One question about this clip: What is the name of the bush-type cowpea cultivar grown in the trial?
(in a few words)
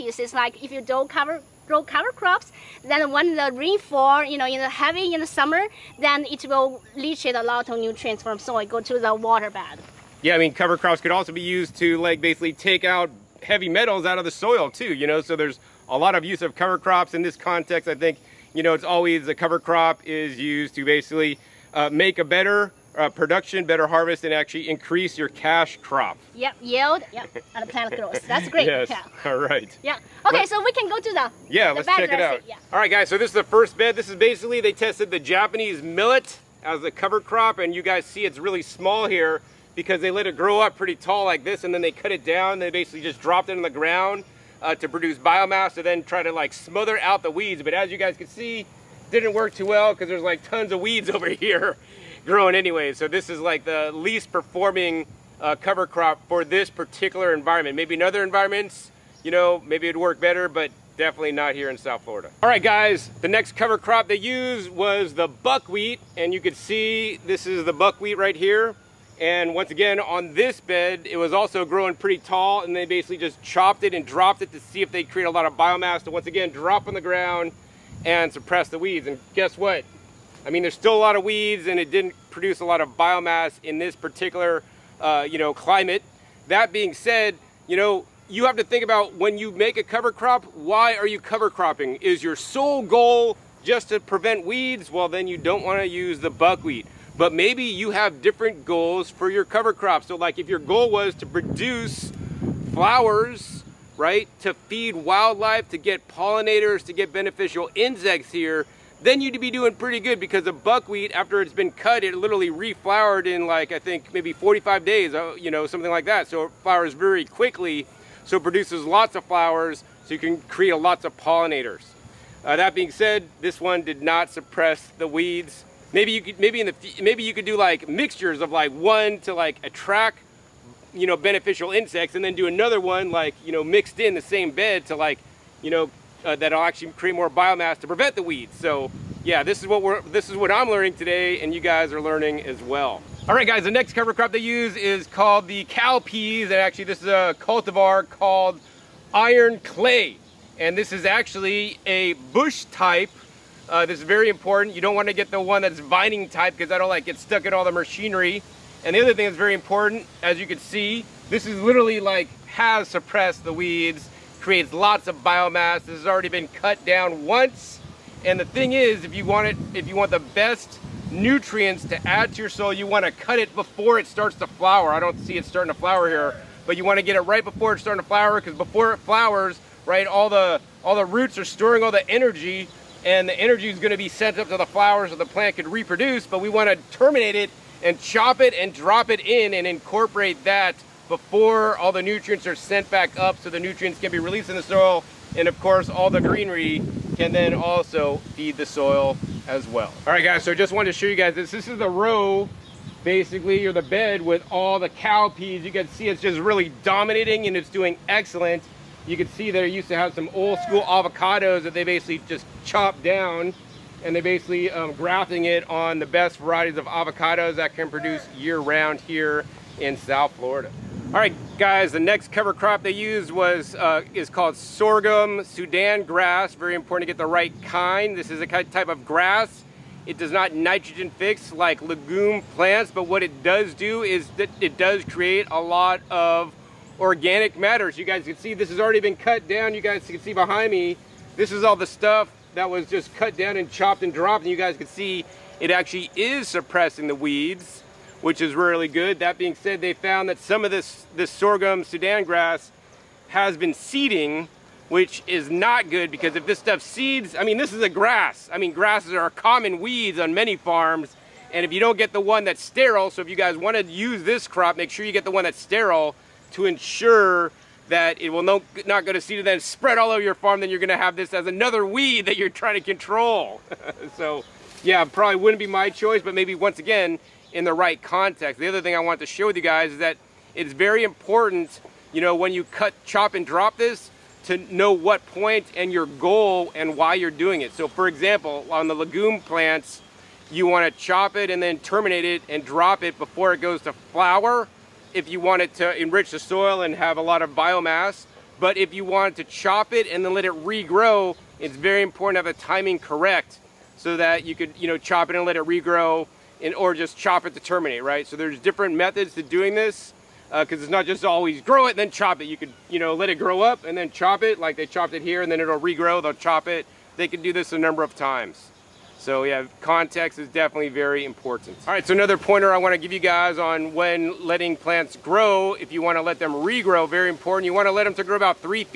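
Iron clay.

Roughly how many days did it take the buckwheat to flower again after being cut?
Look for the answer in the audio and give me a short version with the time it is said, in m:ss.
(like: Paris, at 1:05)
45, at 1:54.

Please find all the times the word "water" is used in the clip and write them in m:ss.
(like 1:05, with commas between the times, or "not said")
0:09.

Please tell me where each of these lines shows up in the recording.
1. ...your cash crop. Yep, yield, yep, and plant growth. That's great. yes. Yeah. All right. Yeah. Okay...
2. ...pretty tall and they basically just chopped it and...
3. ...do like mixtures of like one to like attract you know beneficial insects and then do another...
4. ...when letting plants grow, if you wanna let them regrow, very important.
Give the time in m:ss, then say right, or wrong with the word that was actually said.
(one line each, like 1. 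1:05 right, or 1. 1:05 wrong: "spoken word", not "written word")
1. 0:25 right
2. 1:11 right
3. 2:07 right
4. 5:23 right.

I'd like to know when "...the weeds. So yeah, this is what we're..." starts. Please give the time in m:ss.
2:18.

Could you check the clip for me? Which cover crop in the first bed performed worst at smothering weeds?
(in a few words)
Japanese millet.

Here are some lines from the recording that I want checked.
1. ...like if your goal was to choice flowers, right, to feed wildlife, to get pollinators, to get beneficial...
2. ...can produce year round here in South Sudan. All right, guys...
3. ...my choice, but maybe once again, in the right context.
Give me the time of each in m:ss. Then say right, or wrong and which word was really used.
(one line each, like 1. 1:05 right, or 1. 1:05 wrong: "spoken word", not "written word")
1. 1:40 wrong: "produce", not "choice"
2. 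3:37 wrong: "Florida", not "Sudan"
3. 4:35 right.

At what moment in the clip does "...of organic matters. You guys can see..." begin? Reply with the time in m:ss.
3:56.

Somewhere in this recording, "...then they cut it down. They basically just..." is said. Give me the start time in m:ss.
0:41.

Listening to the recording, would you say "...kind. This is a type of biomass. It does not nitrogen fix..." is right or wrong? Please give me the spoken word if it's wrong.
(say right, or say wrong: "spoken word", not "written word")
wrong: "grass", not "biomass".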